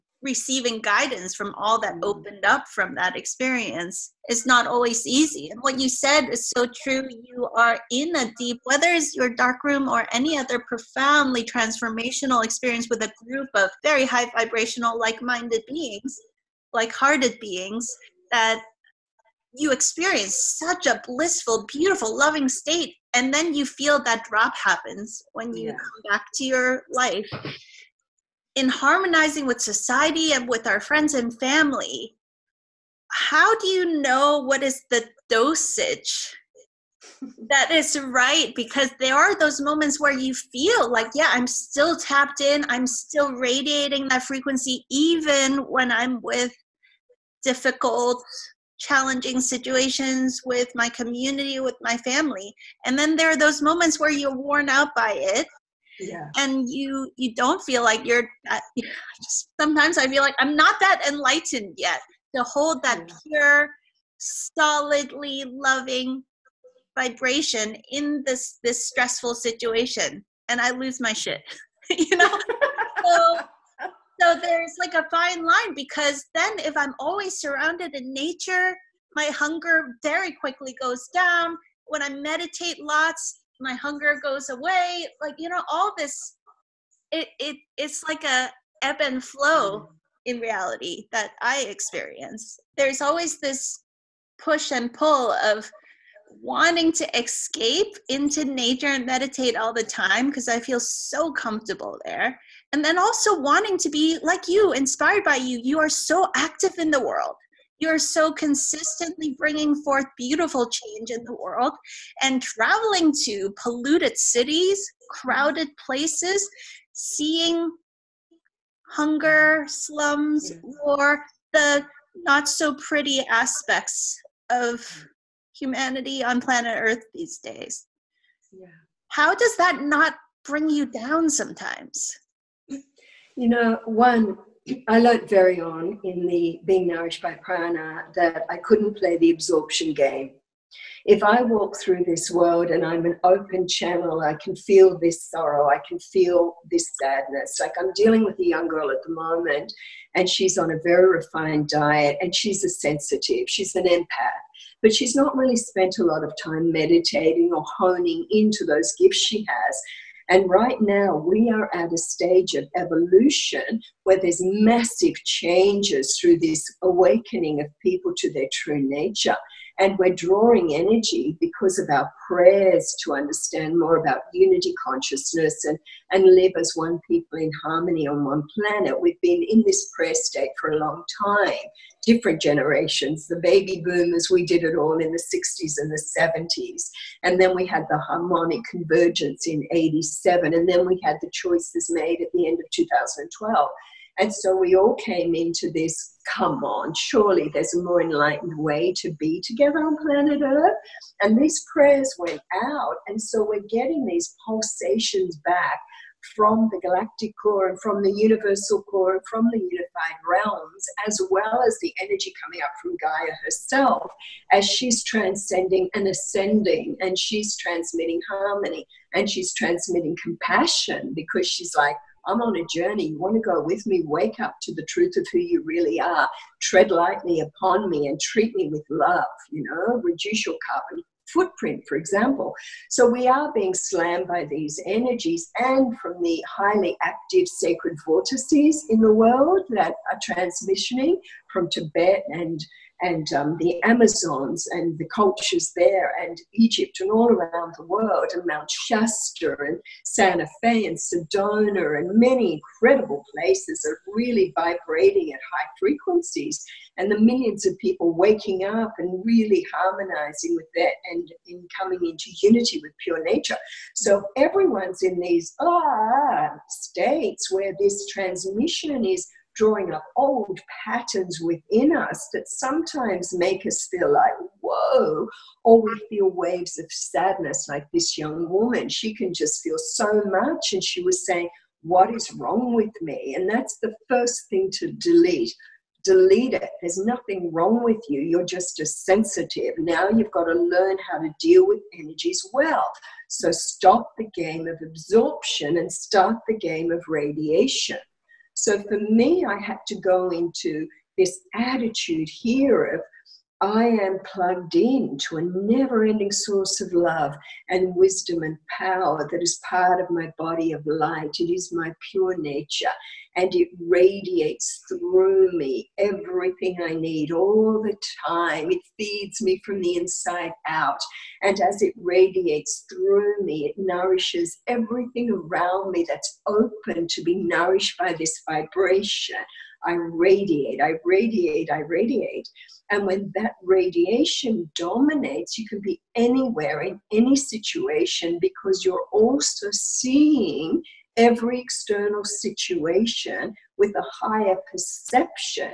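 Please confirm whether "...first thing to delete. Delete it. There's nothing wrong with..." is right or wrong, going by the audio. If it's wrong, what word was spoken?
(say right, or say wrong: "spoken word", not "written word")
right.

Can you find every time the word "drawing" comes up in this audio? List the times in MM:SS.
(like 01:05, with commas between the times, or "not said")
02:50, 04:29.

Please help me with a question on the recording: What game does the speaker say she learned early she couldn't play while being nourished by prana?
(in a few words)
The absorption game.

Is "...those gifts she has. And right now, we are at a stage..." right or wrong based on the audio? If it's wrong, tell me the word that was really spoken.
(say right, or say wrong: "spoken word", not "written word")
right.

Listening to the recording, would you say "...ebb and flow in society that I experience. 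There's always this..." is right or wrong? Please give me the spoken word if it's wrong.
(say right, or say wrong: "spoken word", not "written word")
wrong: "reality", not "society".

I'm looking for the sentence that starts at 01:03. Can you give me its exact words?
pure, solidly loving vibration in this this stressful situation and I lose my shit.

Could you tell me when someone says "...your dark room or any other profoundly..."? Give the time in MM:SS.
00:09.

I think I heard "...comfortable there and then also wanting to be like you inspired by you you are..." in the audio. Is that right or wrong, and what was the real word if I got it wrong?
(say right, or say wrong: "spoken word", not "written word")
right.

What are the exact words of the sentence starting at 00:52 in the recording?
And then there are those moments where you're worn out by it.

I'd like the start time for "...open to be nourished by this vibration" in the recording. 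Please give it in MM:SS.
05:26.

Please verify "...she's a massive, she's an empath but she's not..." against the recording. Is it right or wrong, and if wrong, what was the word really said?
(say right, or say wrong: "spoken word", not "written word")
wrong: "sensitive", not "massive".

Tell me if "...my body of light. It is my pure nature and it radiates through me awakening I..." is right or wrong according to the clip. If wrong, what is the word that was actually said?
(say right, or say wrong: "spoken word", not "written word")
wrong: "everything", not "awakening".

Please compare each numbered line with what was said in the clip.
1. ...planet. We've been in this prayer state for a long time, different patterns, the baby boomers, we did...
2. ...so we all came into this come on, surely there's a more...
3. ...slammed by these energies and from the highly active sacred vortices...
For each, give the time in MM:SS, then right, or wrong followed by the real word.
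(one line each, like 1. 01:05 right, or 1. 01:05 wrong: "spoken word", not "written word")
1. 02:58 wrong: "generations", not "patterns"
2. 03:14 right
3. 03:53 right.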